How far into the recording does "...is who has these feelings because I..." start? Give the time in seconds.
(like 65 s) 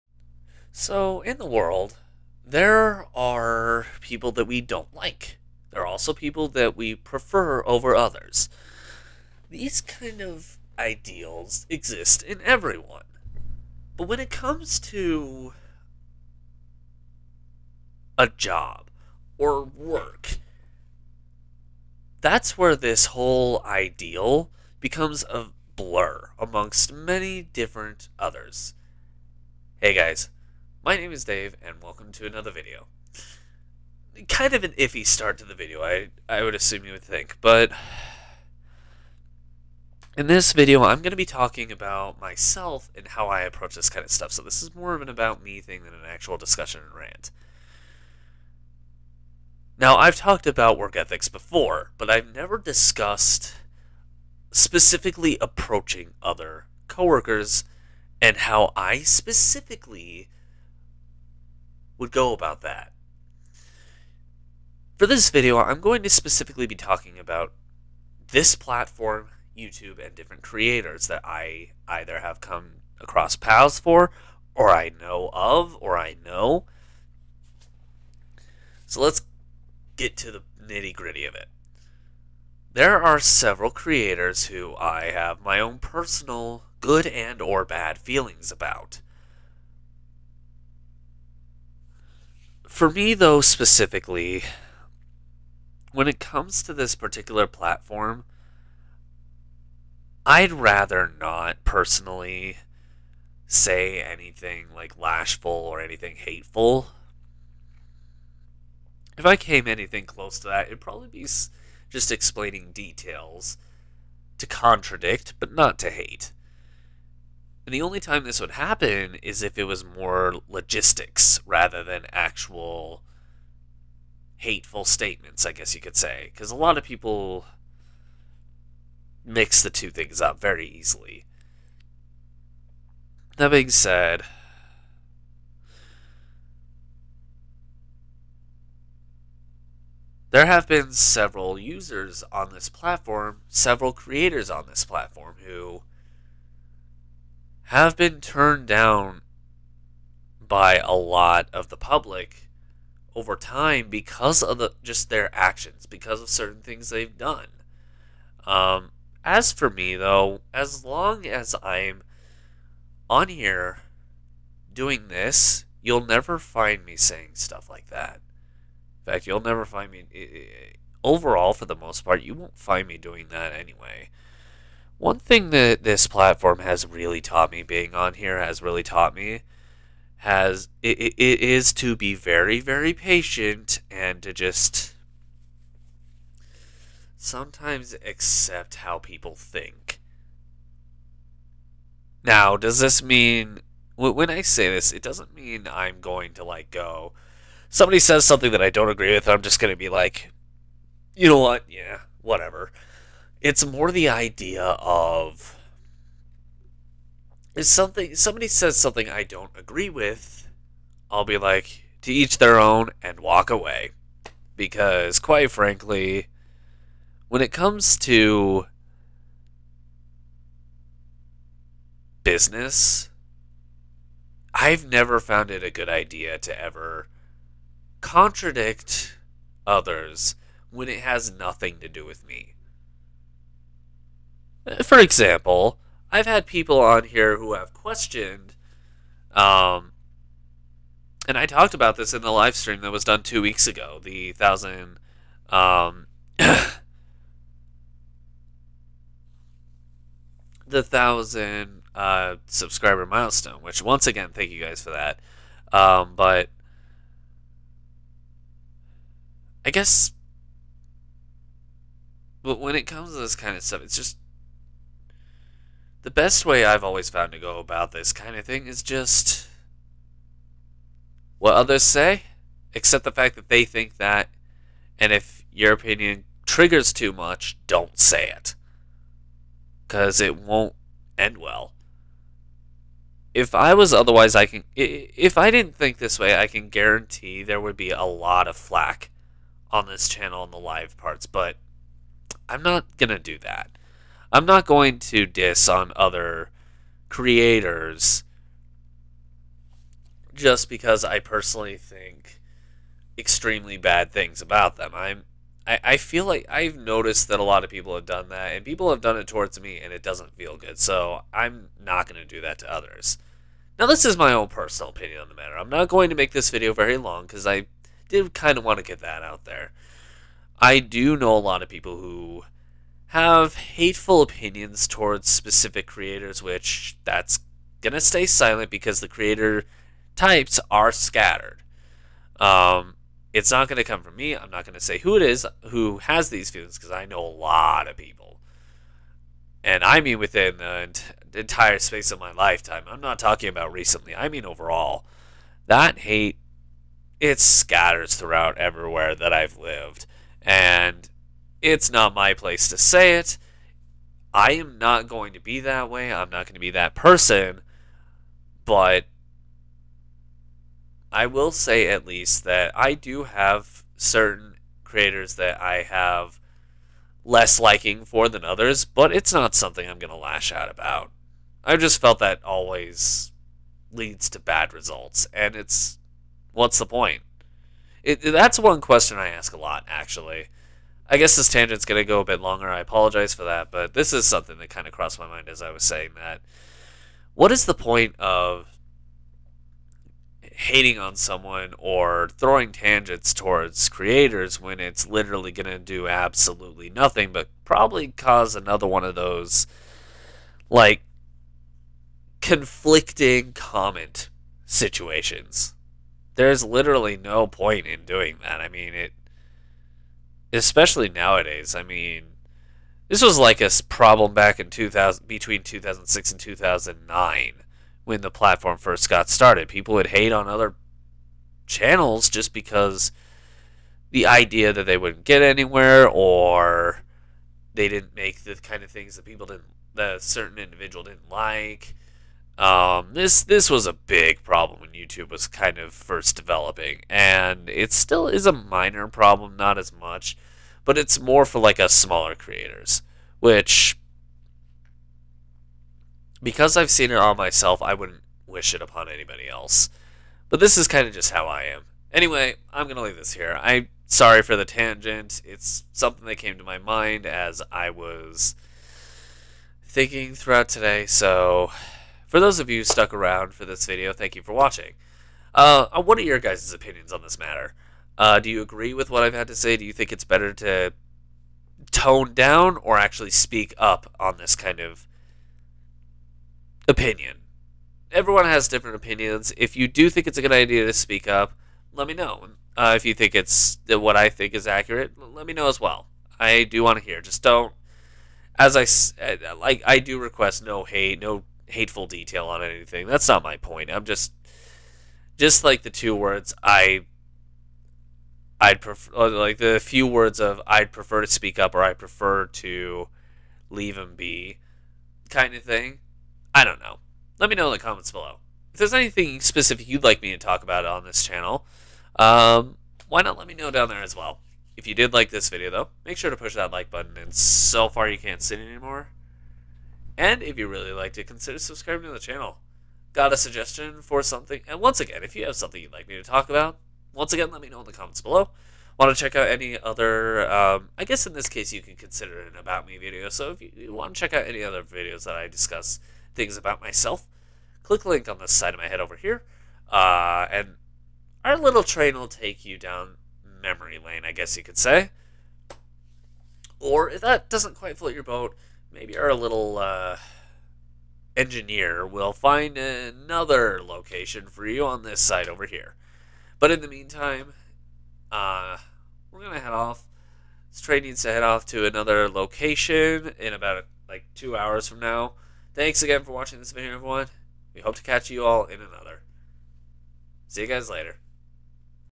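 335 s.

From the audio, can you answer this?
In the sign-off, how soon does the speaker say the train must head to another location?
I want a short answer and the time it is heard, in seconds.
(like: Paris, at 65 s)
two hours, at 564 s.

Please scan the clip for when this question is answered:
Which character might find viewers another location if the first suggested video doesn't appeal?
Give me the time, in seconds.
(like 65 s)
551 s.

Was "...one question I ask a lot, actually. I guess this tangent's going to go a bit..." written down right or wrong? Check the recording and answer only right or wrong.
right.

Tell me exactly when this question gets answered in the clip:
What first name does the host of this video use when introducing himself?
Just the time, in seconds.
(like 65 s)
31 s.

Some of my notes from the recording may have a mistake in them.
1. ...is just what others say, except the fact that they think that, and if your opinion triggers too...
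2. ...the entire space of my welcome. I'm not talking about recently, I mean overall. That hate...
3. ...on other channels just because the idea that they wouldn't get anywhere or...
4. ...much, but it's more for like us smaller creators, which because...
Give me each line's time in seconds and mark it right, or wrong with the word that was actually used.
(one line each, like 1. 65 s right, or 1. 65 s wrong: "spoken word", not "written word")
1. 268 s right
2. 340 s wrong: "lifetime", not "welcome"
3. 420 s right
4. 439 s right.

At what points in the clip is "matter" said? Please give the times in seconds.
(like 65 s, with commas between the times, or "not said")
315 s, 467 s.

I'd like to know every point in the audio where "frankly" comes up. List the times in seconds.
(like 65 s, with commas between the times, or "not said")
215 s.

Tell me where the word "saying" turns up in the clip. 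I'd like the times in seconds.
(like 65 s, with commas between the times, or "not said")
166 s, 385 s.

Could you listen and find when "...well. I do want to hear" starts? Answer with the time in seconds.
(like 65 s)
485 s.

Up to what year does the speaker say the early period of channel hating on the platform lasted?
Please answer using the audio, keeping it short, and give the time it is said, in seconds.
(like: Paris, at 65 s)
2009, at 416 s.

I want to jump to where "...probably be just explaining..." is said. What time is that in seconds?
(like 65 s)
110 s.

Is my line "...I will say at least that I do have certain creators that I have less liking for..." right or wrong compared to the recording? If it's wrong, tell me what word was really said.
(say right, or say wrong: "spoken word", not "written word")
right.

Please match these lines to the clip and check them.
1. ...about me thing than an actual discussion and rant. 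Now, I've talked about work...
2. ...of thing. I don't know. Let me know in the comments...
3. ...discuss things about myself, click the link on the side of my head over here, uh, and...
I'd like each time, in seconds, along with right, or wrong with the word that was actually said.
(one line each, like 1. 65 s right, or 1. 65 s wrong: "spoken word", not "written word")
1. 45 s right
2. 505 s right
3. 535 s right.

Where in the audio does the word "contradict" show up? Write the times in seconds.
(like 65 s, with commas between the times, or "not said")
114 s, 228 s.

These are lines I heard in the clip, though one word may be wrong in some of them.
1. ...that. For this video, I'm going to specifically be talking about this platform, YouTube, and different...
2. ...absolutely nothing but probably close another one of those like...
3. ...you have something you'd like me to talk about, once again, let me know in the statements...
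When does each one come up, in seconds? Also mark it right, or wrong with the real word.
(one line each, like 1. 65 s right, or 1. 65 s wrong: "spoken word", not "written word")
1. 62 s right
2. 396 s wrong: "cause", not "close"
3. 525 s wrong: "comments", not "statements".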